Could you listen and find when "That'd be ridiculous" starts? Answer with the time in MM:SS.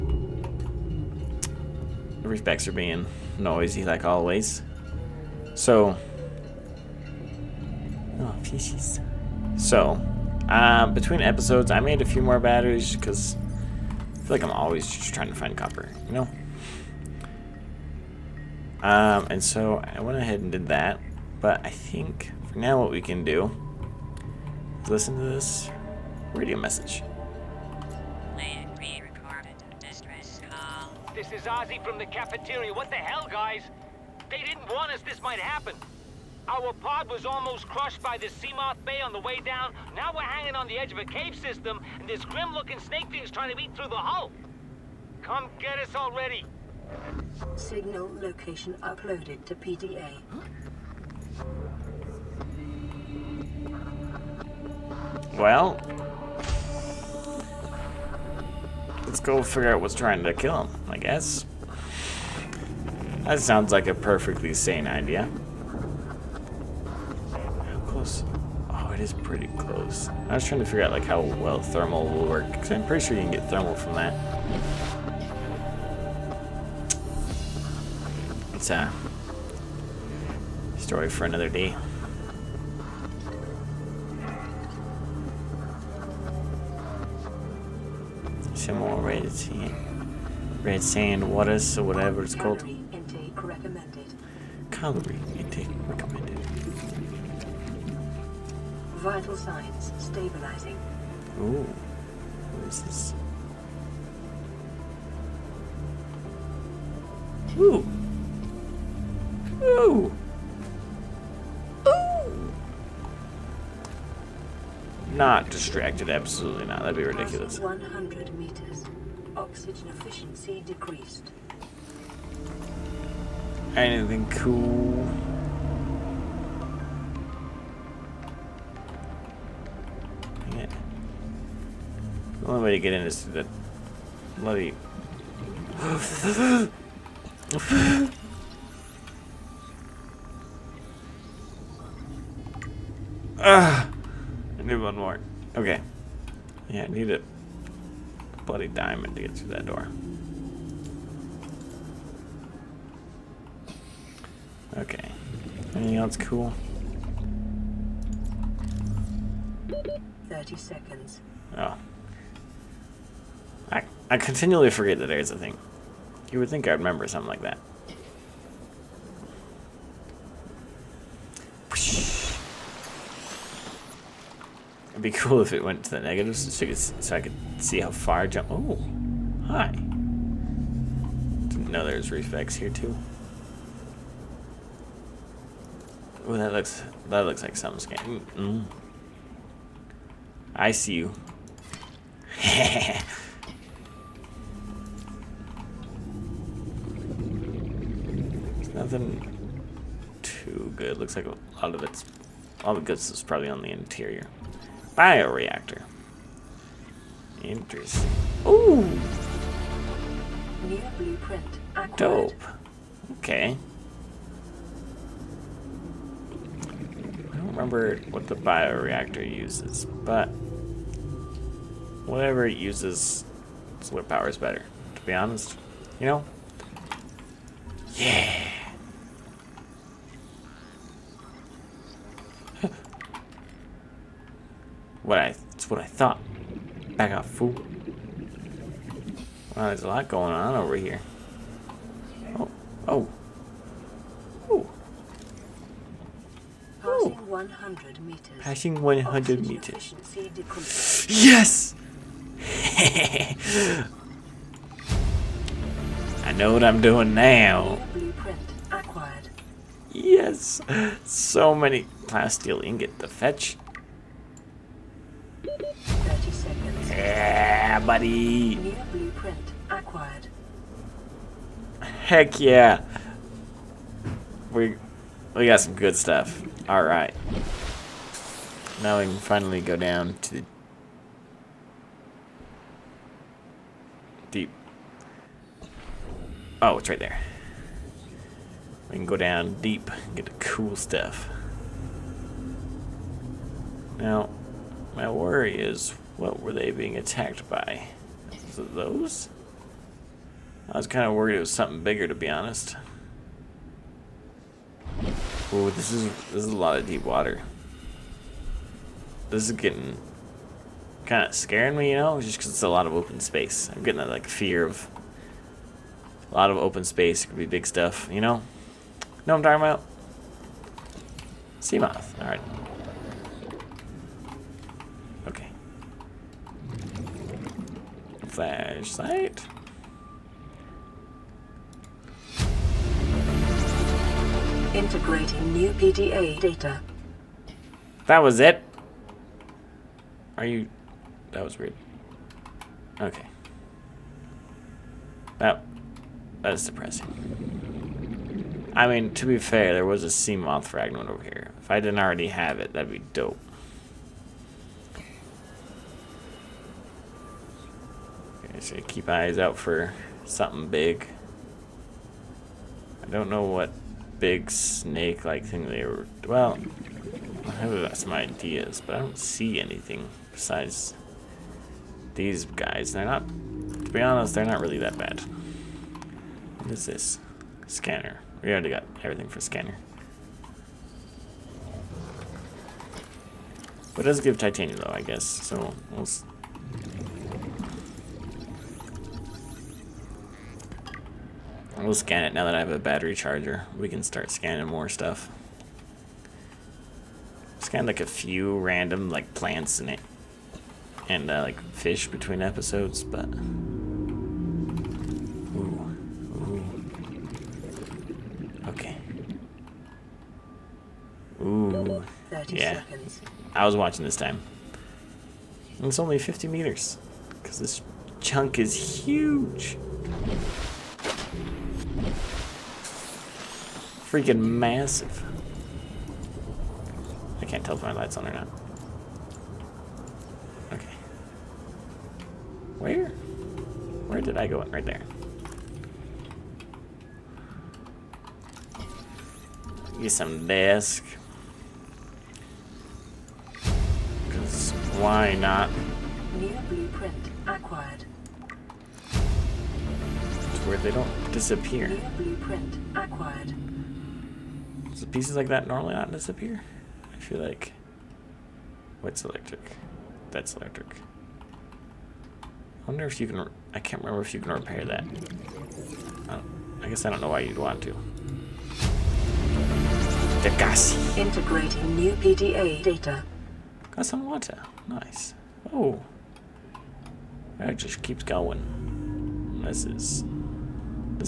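01:56.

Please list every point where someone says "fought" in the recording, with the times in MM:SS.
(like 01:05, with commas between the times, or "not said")
not said.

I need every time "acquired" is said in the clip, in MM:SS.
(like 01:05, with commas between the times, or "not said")
03:31, 04:29, 07:27, 07:32.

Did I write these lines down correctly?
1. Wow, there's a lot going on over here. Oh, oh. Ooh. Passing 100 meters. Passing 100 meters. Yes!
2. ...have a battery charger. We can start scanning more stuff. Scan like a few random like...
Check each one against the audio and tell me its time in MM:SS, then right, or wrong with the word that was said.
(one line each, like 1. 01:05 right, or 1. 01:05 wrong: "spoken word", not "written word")
1. 03:59 right
2. 06:32 right.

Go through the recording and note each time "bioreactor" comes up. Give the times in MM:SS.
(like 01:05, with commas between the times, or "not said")
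03:24, 03:38.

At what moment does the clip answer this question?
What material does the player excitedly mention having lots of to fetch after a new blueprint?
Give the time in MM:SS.
04:22.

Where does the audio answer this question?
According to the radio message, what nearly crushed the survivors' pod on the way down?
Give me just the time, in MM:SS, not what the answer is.
00:38.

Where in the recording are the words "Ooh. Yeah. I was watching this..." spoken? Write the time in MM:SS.
06:51.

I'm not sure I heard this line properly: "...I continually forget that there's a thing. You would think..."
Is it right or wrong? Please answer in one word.
right.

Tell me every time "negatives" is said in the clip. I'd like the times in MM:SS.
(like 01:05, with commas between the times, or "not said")
02:55.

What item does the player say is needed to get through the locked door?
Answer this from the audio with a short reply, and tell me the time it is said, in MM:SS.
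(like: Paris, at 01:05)
diamond, at 02:28.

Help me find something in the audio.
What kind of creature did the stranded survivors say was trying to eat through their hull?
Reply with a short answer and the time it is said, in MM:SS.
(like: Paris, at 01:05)
snake thing, at 00:42.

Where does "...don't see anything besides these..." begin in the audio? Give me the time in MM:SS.
06:08.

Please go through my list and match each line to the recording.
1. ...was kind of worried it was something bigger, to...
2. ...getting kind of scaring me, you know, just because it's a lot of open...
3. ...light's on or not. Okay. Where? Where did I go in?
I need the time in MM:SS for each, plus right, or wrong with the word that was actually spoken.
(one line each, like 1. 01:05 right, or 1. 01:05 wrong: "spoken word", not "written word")
1. 05:00 right
2. 05:09 right
3. 07:07 right.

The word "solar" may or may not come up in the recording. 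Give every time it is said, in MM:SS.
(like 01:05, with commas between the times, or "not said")
03:43.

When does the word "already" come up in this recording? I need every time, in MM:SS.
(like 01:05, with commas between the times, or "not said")
00:45, 05:51, 06:18.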